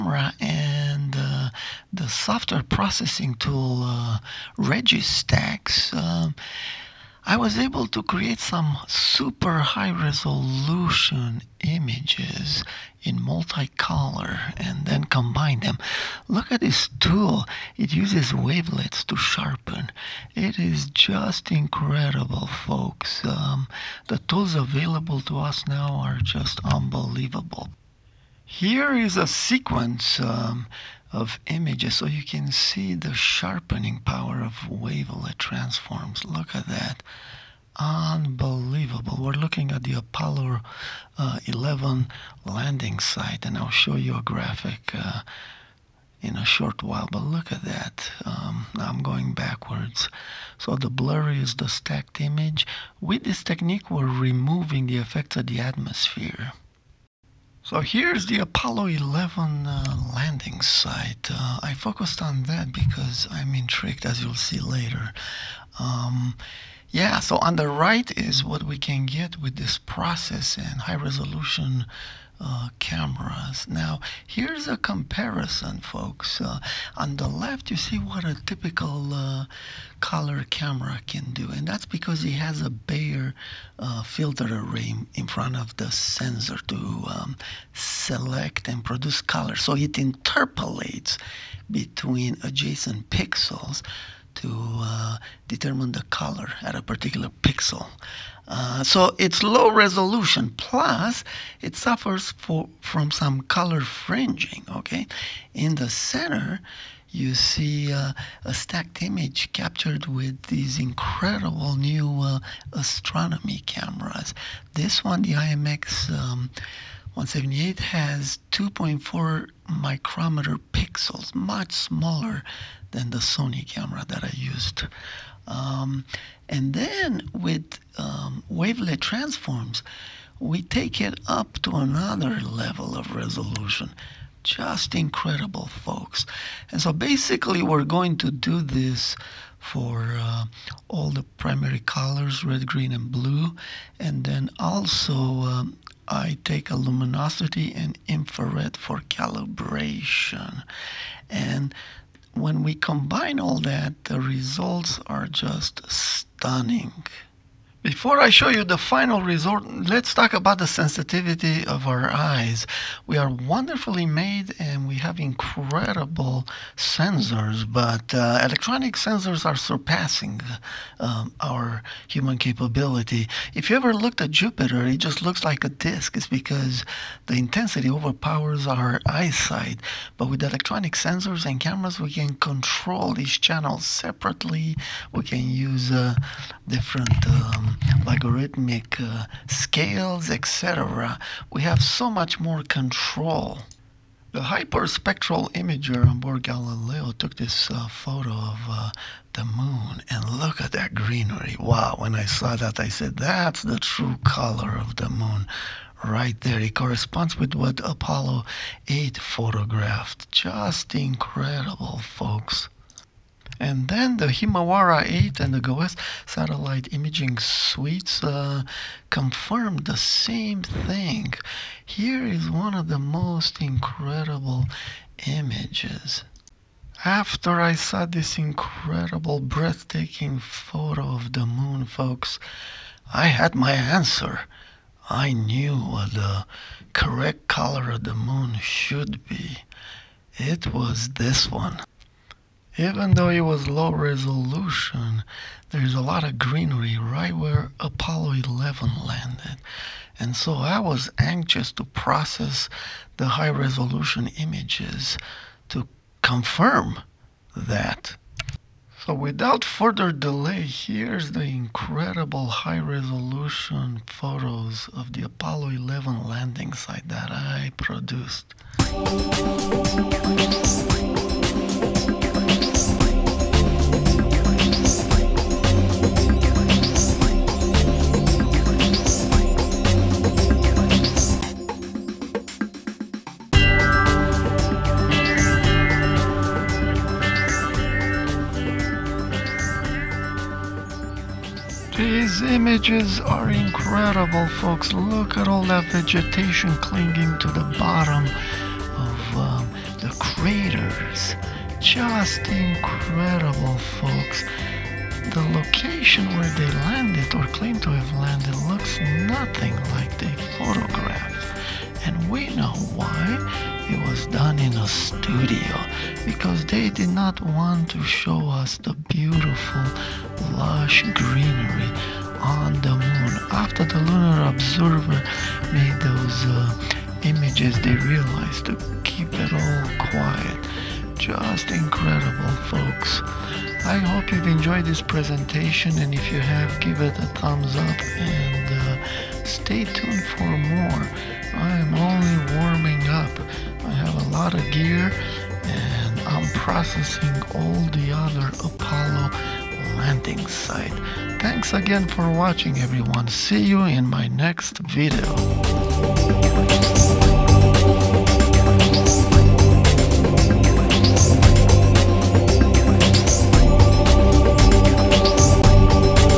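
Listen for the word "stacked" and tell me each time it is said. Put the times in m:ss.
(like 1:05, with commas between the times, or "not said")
0:51, 1:48.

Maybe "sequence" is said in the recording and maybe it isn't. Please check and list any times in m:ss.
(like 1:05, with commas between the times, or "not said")
0:29.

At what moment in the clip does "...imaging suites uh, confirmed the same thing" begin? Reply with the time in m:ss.
3:36.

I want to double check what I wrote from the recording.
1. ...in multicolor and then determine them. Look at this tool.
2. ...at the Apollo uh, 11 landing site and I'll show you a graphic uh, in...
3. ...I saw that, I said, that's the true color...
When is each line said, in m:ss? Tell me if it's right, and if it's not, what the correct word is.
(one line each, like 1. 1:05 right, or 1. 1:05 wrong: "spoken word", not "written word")
1. 0:13 wrong: "combine", not "determine"
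2. 0:39 right
3. 3:22 right.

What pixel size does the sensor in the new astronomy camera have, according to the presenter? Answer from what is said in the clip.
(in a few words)
2.4 micrometers.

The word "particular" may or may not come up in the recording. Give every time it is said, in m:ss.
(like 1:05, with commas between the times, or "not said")
1:36.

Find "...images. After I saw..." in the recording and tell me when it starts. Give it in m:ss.
3:45.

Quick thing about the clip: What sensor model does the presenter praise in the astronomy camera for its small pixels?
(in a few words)
IMX 178.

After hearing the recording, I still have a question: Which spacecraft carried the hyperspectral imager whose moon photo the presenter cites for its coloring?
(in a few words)
Galileo.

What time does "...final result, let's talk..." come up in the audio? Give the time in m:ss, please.
2:38.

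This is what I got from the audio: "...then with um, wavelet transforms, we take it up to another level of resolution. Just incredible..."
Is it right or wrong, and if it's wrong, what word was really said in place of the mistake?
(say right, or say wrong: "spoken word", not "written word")
right.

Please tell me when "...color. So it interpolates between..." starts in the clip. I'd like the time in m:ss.
1:29.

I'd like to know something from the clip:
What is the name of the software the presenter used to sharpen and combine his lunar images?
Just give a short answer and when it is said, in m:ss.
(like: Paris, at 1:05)
Registax, at 0:04.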